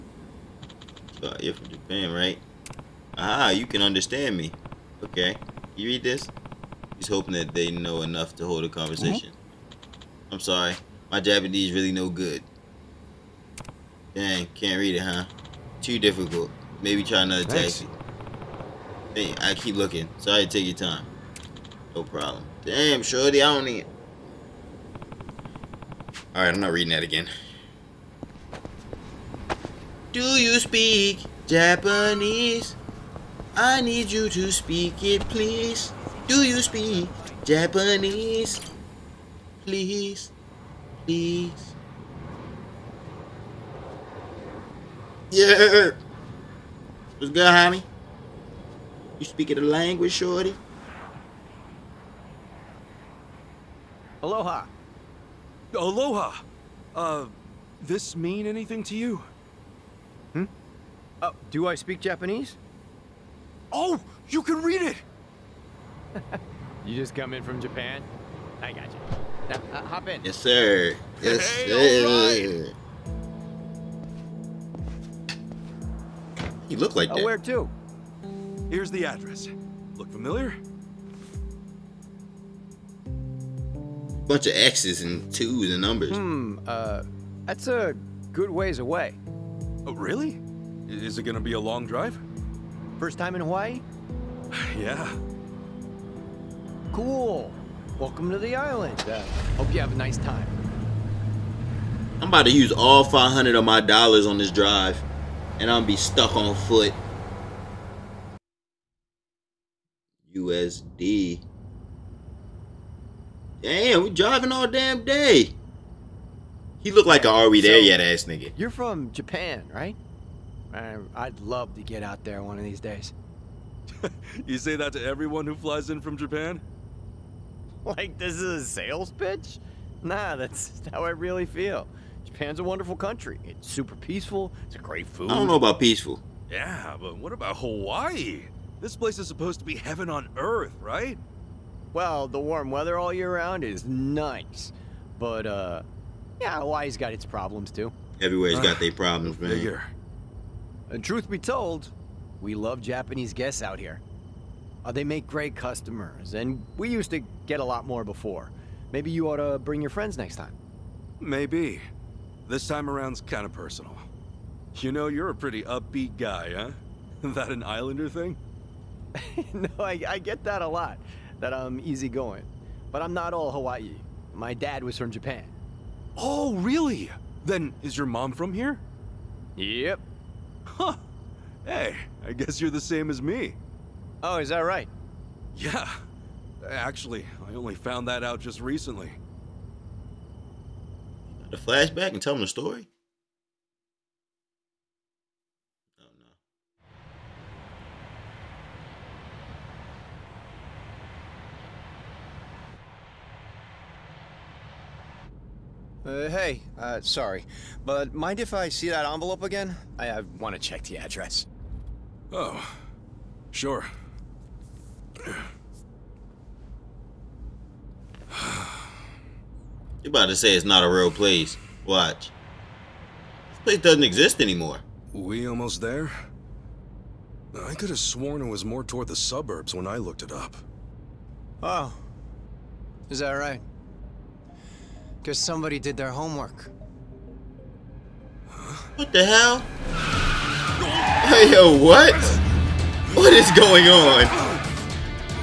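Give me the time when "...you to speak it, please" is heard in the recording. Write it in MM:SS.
00:34.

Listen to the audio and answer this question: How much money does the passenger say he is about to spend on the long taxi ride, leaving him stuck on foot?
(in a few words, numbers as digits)
$500.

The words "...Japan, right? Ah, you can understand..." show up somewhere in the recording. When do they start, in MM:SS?
00:01.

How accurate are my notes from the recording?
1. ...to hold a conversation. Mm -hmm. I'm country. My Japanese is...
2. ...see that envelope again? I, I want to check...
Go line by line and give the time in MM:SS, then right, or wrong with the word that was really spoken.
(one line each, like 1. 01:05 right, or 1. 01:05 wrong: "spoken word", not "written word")
1. 00:08 wrong: "sorry", not "country"
2. 03:28 right.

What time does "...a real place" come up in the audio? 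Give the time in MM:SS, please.
03:40.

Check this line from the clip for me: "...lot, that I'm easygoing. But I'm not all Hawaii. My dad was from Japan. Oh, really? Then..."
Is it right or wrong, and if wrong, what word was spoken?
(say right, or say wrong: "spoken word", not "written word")
right.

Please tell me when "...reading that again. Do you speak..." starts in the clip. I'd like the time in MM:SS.
00:26.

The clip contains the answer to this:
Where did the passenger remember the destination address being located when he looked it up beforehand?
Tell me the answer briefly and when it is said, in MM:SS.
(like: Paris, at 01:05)
the suburbs, at 03:49.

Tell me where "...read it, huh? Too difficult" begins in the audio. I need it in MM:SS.
00:14.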